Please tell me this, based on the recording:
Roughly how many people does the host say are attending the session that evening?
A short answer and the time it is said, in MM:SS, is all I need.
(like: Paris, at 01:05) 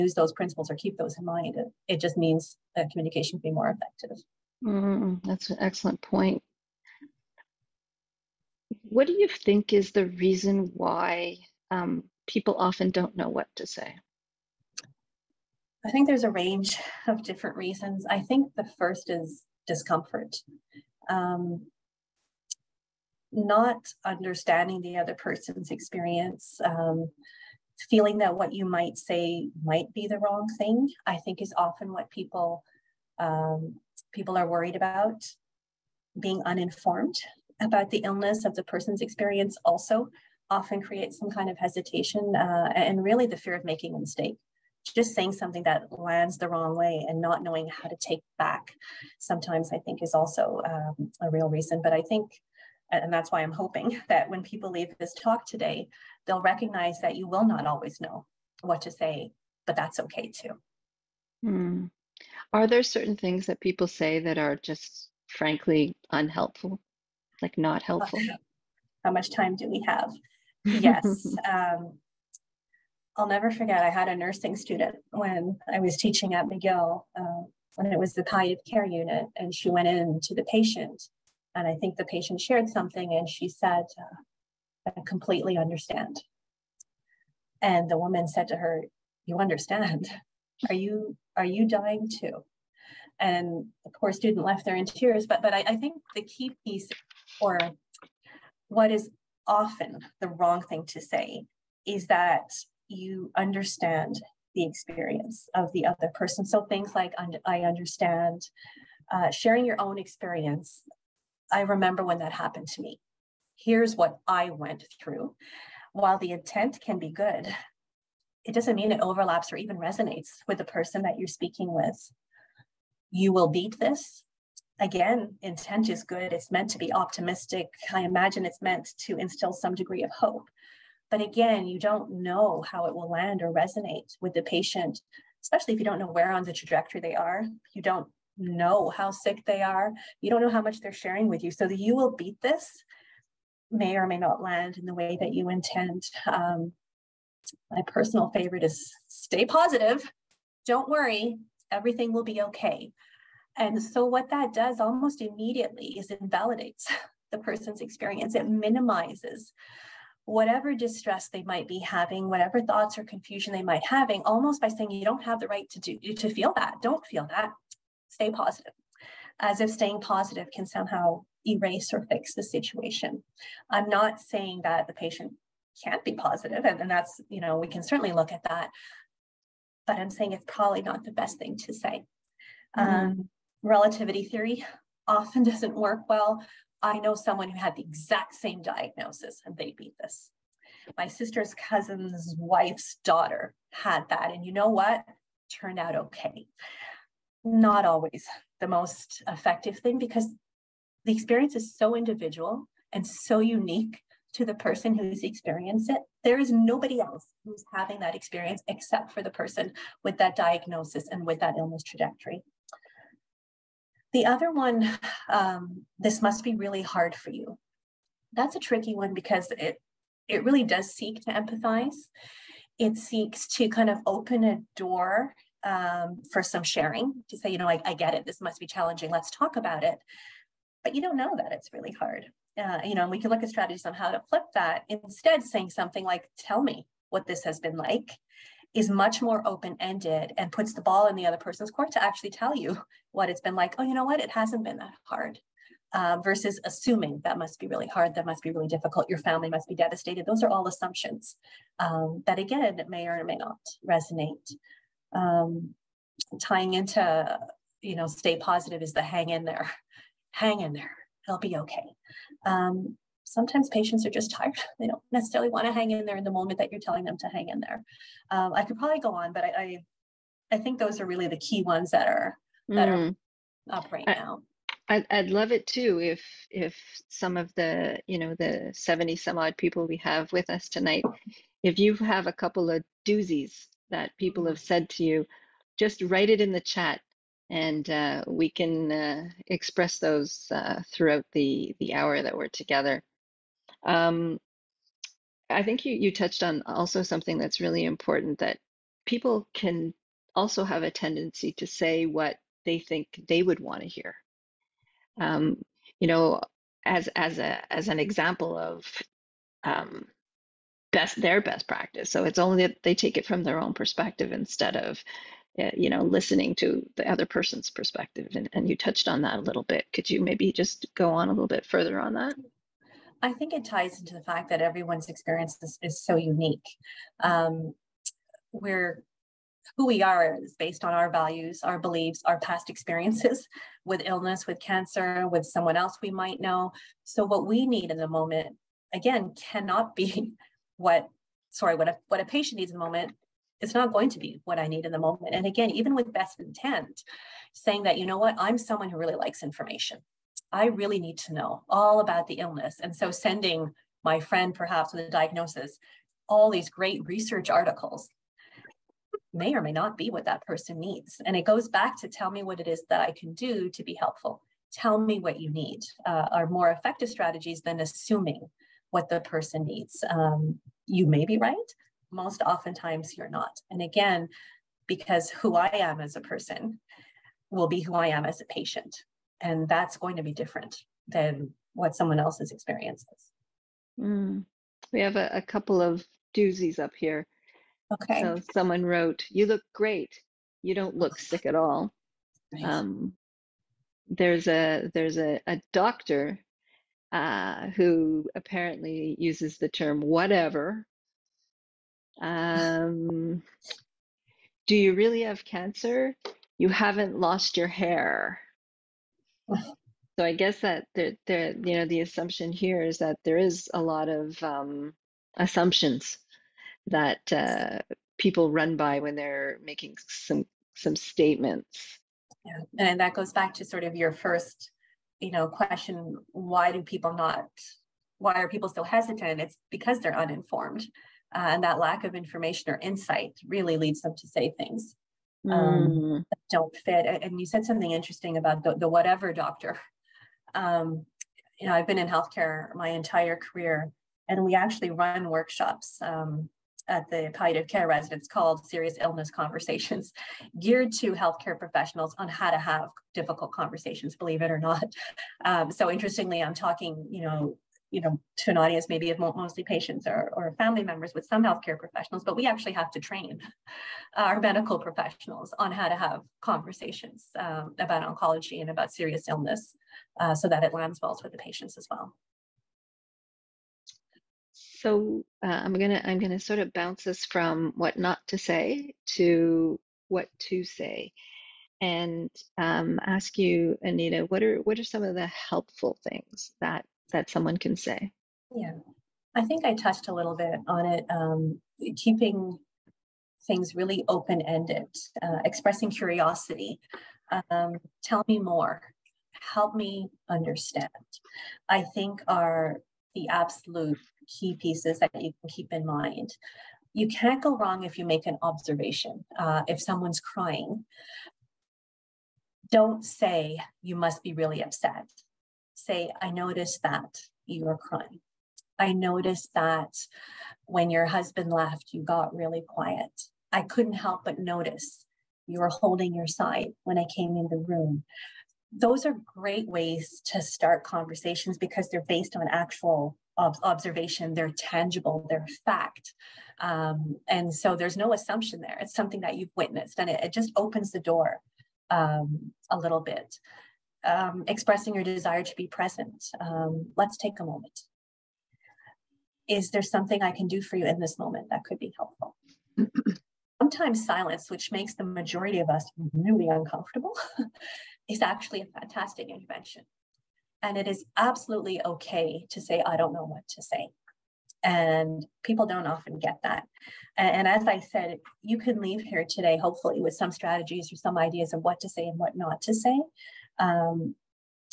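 70, at 04:38.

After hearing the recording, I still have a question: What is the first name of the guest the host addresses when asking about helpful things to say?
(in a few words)
Anita.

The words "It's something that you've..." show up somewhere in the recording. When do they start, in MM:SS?
08:58.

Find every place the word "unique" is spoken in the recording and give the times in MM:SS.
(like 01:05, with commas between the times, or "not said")
03:23, 05:26.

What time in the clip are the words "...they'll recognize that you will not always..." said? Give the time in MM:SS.
00:56.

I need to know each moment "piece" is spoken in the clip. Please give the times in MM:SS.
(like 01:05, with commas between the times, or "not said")
01:36, 08:24.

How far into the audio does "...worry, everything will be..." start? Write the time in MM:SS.
02:30.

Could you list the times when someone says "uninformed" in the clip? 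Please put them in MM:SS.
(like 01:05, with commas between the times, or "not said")
00:36, 07:10.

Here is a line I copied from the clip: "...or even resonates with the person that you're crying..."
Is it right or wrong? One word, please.
wrong.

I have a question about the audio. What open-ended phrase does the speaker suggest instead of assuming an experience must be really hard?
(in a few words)
Tell me what this has been like.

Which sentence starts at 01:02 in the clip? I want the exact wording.
are there certain things that people say that are just frankly unhelpful like not helpful.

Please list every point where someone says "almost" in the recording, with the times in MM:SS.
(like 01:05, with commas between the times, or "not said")
02:34, 02:44.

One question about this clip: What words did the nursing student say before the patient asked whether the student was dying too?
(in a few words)
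I completely understand.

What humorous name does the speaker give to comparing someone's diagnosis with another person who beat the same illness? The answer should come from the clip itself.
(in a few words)
Relativity theory.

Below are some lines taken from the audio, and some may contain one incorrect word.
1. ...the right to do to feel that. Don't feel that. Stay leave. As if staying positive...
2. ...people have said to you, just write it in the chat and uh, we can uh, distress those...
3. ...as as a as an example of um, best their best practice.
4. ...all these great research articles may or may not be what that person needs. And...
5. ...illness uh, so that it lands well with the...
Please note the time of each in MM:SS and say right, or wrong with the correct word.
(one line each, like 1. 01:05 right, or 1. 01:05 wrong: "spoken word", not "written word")
1. 02:45 wrong: "positive", not "leave"
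2. 04:44 wrong: "express", not "distress"
3. 05:06 right
4. 05:56 right
5. 07:49 right.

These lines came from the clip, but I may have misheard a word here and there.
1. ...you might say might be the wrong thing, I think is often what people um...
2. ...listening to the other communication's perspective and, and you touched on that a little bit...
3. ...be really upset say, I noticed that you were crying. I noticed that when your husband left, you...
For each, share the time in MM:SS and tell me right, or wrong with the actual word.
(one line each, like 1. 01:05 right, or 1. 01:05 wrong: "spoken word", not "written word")
1. 00:28 right
2. 05:16 wrong: "person", not "communication"
3. 08:34 right.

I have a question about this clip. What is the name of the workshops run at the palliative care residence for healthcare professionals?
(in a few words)
Serious Illness Conversations.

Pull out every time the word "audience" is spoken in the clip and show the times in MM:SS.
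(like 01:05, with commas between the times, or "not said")
07:38.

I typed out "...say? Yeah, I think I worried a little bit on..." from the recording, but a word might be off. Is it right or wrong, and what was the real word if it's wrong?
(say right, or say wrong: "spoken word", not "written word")
wrong: "touched", not "worried".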